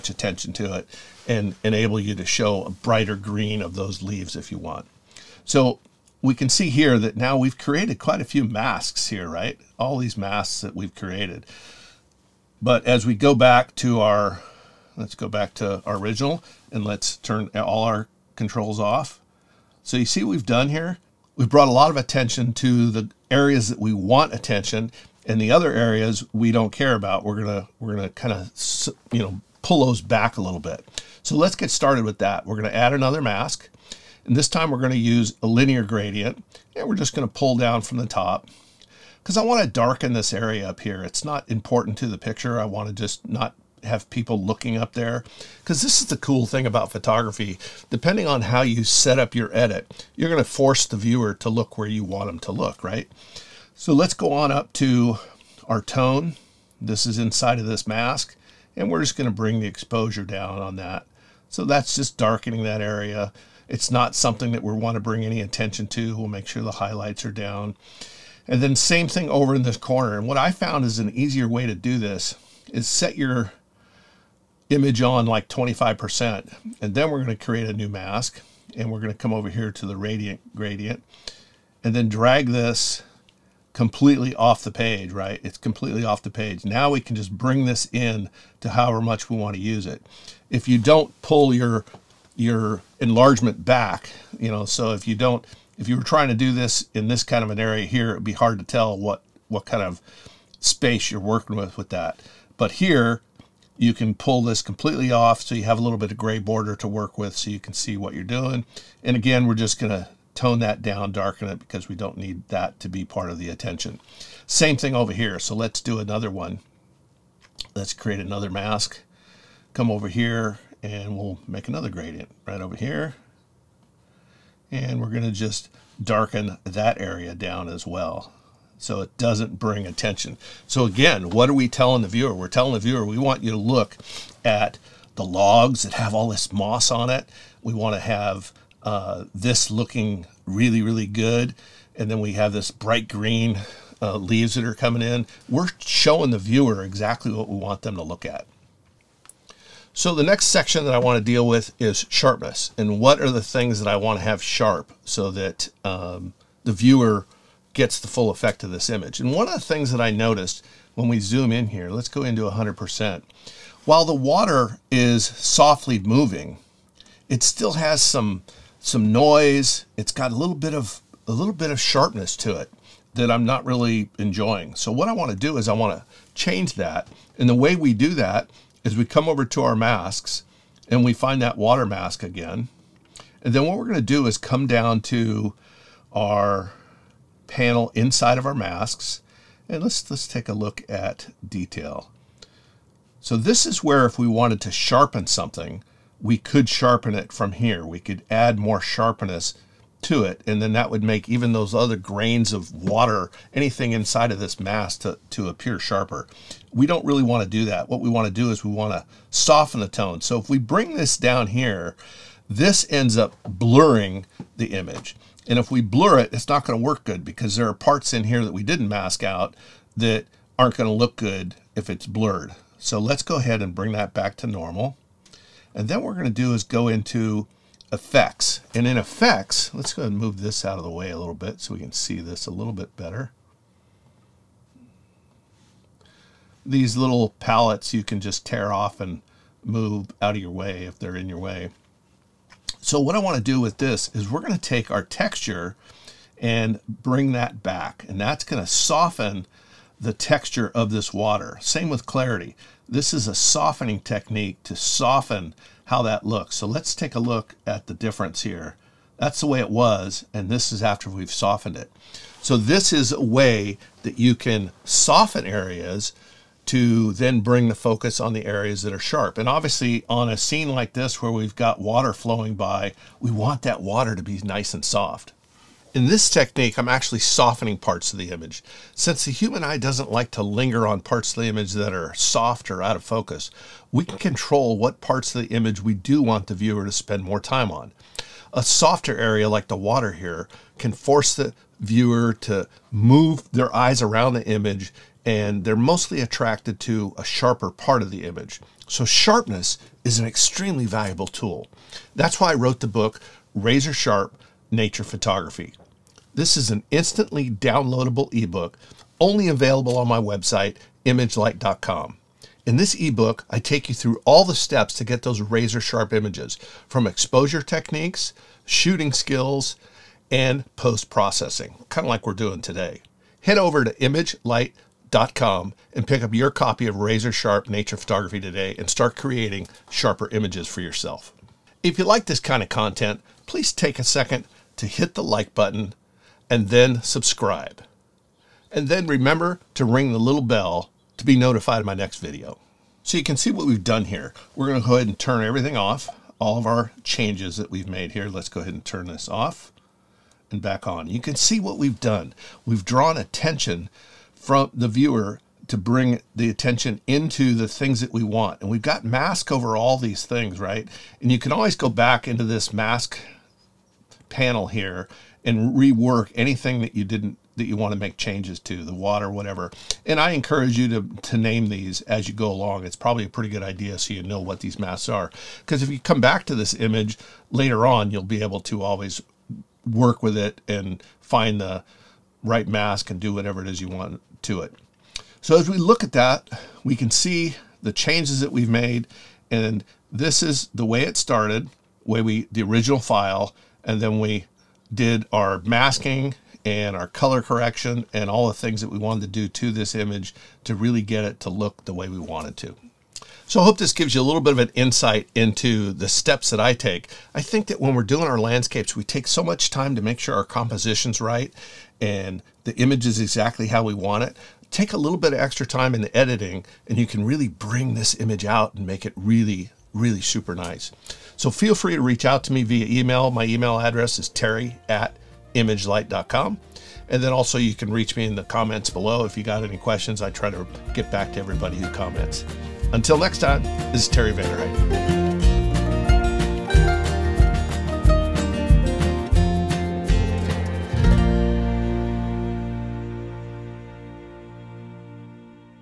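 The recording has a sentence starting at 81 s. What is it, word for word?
And then drag this completely off the page, right?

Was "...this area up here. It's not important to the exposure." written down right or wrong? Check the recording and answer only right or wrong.
wrong.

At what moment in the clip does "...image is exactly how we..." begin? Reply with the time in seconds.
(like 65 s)
412 s.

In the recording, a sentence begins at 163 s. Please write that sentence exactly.
While the water is softly moving, it still has some some noise.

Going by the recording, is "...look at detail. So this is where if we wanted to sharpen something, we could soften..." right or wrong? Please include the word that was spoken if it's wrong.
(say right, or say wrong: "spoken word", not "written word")
wrong: "sharpen", not "soften".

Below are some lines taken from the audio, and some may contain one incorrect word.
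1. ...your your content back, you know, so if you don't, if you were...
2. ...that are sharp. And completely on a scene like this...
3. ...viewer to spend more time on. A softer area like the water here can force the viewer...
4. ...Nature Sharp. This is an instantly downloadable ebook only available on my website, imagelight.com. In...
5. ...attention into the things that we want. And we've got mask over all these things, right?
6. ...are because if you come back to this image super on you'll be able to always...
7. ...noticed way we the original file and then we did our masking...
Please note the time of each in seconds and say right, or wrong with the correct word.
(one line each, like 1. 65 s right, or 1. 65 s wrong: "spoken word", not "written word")
1. 91 s wrong: "enlargement", not "content"
2. 268 s wrong: "obviously", not "completely"
3. 286 s right
4. 304 s wrong: "Photography", not "Sharp"
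5. 356 s right
6. 375 s wrong: "later", not "super"
7. 391 s wrong: "started", not "noticed".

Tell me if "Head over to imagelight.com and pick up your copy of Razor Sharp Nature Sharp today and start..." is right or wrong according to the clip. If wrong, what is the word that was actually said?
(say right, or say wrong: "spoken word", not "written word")
wrong: "Photography", not "Sharp".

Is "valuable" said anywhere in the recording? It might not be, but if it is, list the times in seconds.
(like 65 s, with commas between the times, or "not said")
300 s.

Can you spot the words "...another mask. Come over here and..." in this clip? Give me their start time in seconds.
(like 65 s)
118 s.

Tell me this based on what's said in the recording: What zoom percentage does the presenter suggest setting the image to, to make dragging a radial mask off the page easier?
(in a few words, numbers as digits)
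25%.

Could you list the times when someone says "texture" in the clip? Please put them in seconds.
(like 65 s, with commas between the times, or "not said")
245 s, 250 s.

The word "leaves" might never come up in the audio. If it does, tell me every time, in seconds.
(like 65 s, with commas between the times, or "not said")
4 s, 144 s.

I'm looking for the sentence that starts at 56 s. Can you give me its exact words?
This is inside of this mask, and we're just going to bring the exposure down on that.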